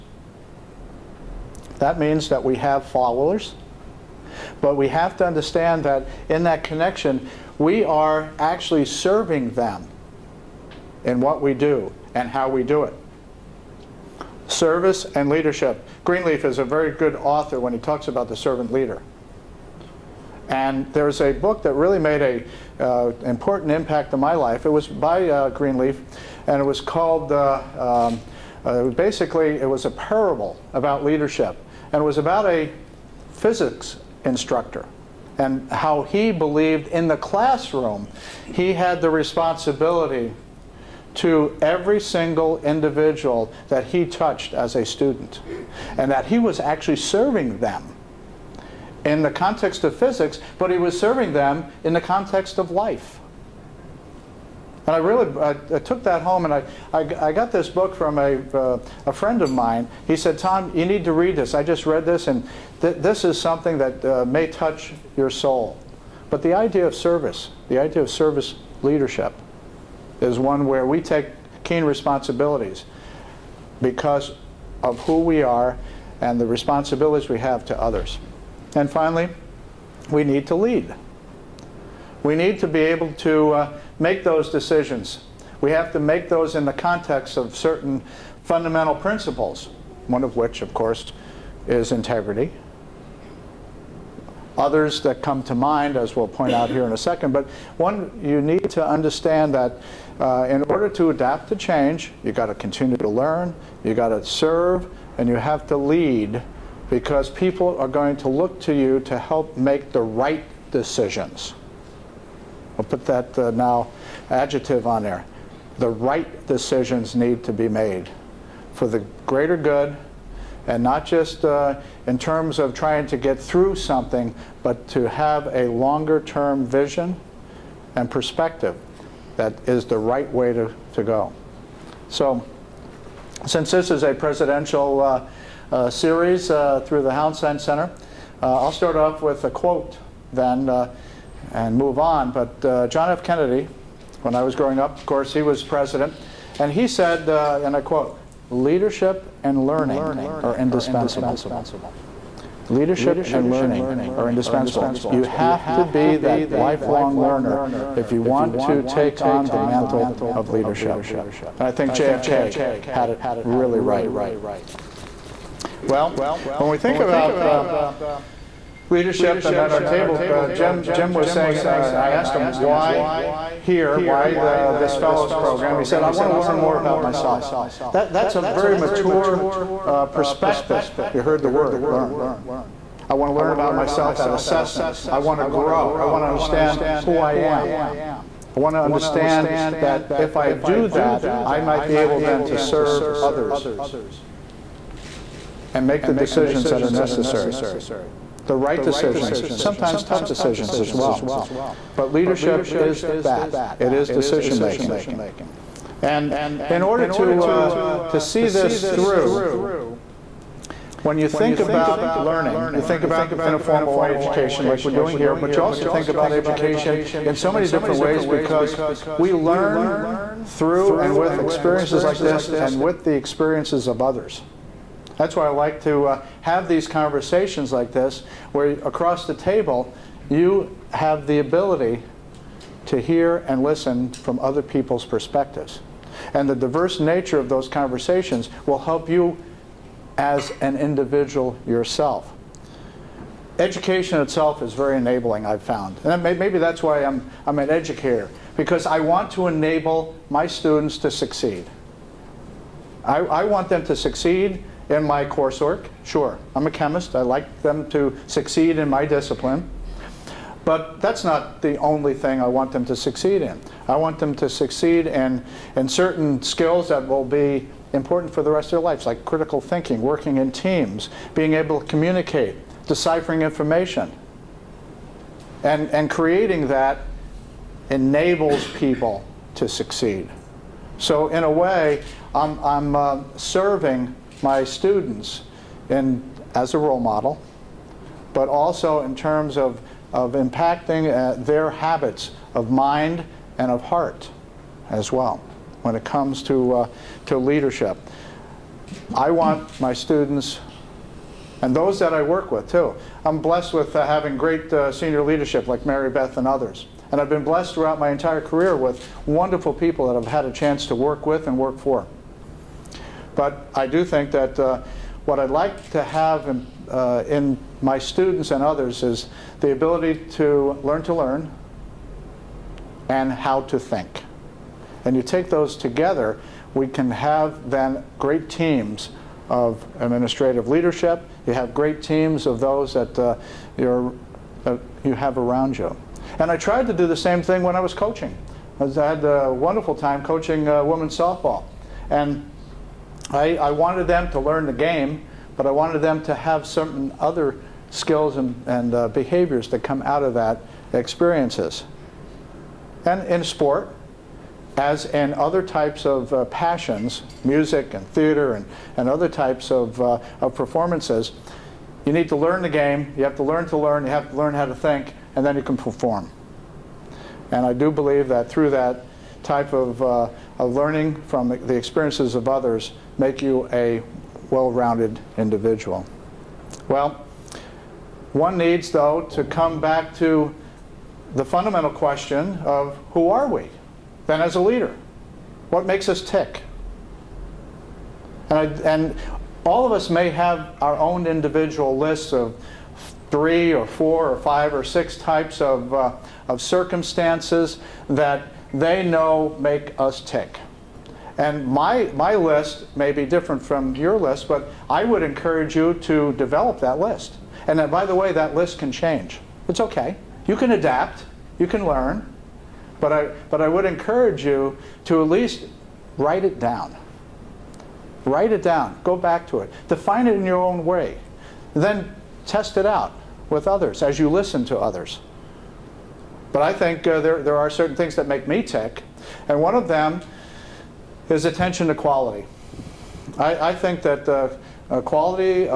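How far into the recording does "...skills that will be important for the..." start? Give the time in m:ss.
4:26.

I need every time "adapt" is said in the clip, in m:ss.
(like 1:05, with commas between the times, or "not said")
1:41, 6:50.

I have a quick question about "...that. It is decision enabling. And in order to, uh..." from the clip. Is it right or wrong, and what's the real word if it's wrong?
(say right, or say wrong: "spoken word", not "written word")
wrong: "making", not "enabling".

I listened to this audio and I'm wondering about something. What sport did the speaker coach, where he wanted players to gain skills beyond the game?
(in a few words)
Women's softball.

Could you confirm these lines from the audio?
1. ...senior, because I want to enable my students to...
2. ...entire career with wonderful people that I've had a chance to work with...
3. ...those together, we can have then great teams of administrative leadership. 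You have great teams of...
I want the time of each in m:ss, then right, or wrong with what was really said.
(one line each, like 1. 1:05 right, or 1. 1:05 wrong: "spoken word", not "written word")
1. 4:07 wrong: "educator", not "senior"
2. 5:08 right
3. 5:25 right.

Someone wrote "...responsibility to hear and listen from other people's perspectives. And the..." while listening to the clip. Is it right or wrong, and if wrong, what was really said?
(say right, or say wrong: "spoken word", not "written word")
wrong: "ability", not "responsibility".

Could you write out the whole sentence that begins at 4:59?
I want my students and those that I work with too.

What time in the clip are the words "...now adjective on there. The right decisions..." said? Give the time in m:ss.
1:53.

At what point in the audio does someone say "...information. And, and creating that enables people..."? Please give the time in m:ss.
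4:33.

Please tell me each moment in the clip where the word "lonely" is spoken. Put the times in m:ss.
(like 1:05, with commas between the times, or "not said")
not said.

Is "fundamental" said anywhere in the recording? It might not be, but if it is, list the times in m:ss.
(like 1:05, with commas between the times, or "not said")
1:28, 6:21.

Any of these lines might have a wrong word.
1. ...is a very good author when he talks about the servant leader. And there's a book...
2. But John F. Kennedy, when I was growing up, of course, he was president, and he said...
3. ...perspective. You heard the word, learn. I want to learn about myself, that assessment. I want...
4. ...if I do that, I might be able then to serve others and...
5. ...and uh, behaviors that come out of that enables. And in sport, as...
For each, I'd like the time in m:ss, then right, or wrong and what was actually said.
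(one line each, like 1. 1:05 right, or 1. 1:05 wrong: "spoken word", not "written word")
1. 0:16 right
2. 2:22 right
3. 3:00 right
4. 3:10 right
5. 5:48 wrong: "experiences", not "enables".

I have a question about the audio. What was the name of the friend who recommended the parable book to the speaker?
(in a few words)
Tom.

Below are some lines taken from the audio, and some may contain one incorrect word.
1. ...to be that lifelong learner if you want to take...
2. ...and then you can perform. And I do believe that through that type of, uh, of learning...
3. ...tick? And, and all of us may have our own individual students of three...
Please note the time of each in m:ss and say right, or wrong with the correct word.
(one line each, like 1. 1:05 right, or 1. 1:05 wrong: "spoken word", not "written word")
1. 2:35 right
2. 6:05 right
3. 6:26 wrong: "lists", not "students".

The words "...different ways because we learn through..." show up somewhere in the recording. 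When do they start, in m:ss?
3:37.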